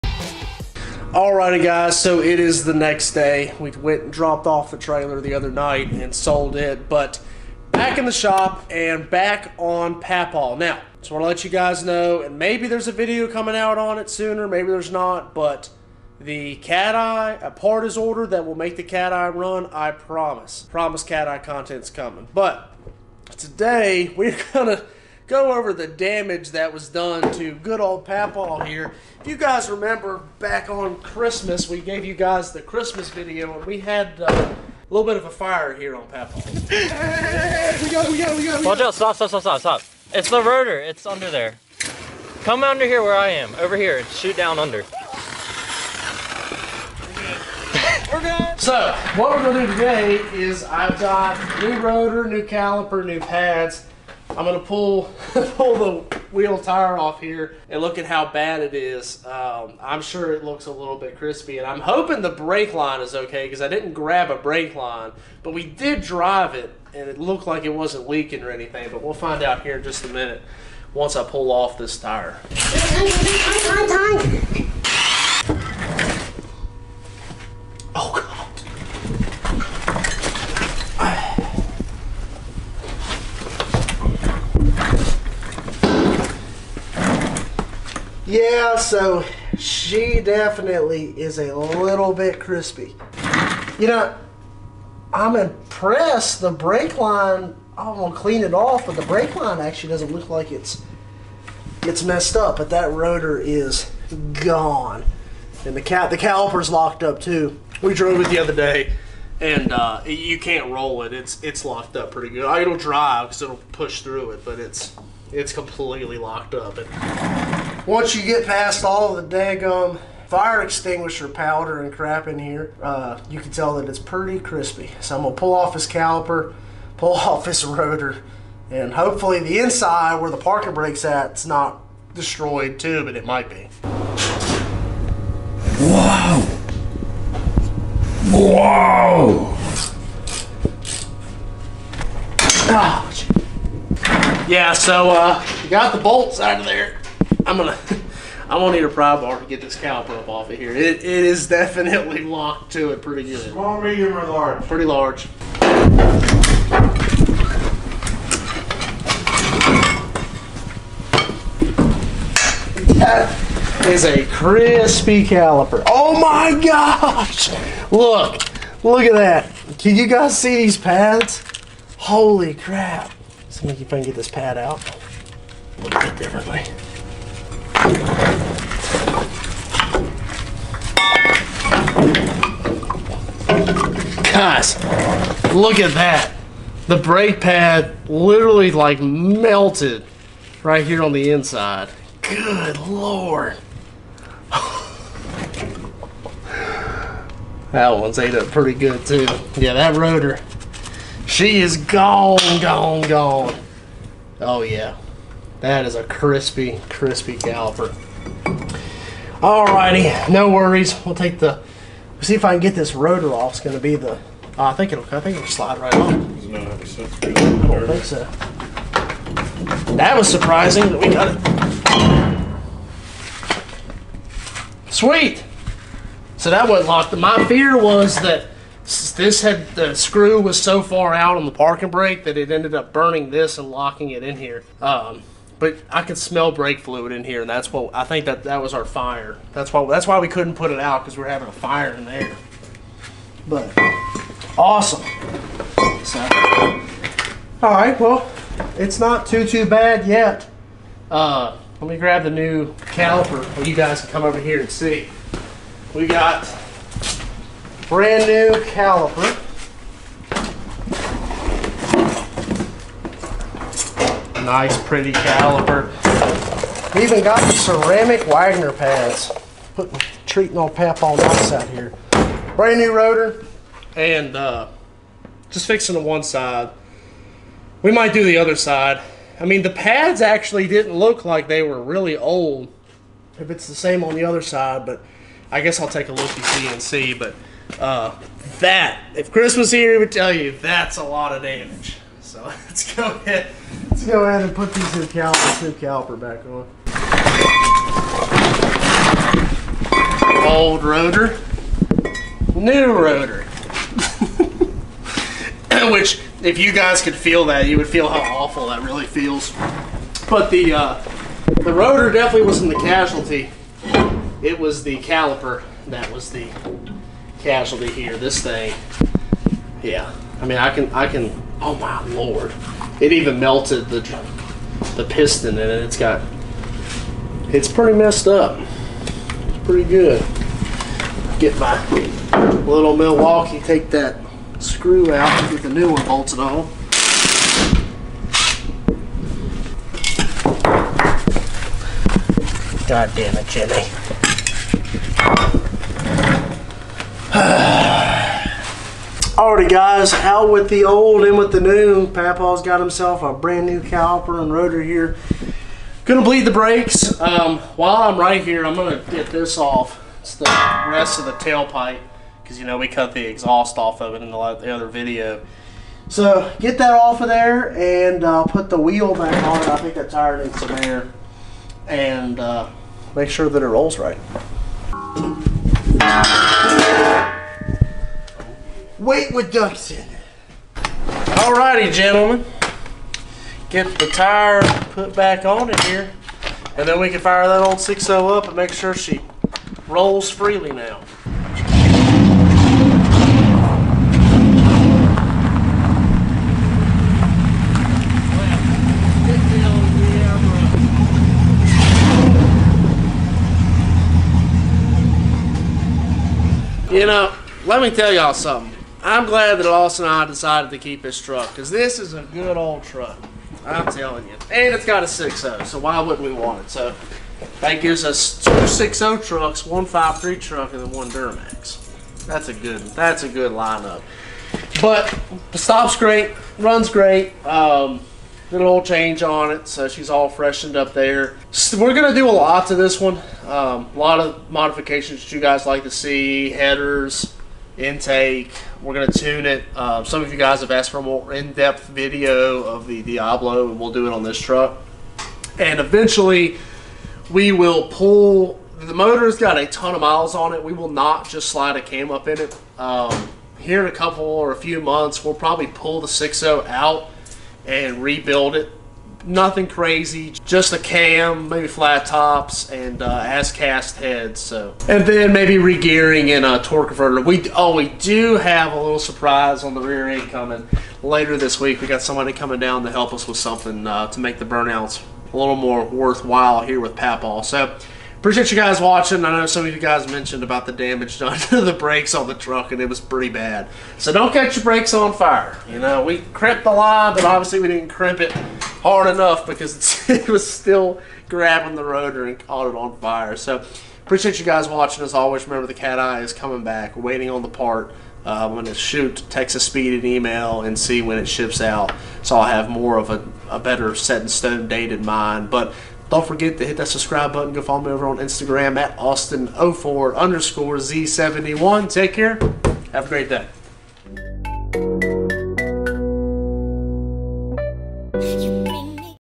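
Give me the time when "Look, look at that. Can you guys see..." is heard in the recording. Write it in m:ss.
2:47.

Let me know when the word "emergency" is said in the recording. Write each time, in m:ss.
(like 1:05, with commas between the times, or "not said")
not said.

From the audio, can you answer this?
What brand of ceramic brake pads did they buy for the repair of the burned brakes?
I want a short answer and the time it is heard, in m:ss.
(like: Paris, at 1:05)
Wagner, at 4:28.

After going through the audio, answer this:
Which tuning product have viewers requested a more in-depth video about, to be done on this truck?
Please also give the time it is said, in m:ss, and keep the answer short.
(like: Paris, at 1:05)
Diablo, at 7:23.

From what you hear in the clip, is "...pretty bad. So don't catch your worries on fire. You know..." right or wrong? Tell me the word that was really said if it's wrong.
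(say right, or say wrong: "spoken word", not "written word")
wrong: "brakes", not "worries".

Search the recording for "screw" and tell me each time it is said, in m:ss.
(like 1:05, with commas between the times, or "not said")
3:49, 5:34.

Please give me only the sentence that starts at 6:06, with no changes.
So get that off of there and uh, put the wheel back on.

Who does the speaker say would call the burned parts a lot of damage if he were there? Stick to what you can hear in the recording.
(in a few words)
Chris.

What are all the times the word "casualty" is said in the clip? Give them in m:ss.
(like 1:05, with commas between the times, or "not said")
5:12, 5:17.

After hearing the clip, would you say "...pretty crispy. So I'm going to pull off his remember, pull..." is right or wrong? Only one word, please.
wrong.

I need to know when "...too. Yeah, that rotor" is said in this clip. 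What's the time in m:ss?
3:19.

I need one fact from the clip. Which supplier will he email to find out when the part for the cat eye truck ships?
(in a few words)
Texas Speed.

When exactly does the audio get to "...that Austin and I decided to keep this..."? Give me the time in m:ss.
6:49.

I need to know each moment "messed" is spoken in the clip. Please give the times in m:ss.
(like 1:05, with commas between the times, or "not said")
1:42, 5:27.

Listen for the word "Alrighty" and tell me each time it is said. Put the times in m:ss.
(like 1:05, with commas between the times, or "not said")
0:01, 3:29, 5:49, 6:20.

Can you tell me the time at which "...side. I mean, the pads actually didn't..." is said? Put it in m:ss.
4:38.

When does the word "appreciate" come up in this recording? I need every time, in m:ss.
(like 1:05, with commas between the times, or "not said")
7:58, 8:14.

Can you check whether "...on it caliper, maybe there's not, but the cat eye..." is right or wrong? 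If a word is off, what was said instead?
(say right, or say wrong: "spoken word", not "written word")
wrong: "sooner", not "caliper".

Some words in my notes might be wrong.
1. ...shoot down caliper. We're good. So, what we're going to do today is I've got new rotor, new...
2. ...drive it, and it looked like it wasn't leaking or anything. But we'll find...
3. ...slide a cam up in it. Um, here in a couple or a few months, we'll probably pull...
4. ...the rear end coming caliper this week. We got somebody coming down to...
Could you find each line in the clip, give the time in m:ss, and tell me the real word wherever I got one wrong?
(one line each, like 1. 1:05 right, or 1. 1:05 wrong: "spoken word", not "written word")
1. 0:44 wrong: "under", not "caliper"
2. 1:06 right
3. 7:31 right
4. 7:49 wrong: "later", not "caliper".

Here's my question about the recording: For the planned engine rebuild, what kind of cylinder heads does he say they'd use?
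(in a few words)
As cast heads.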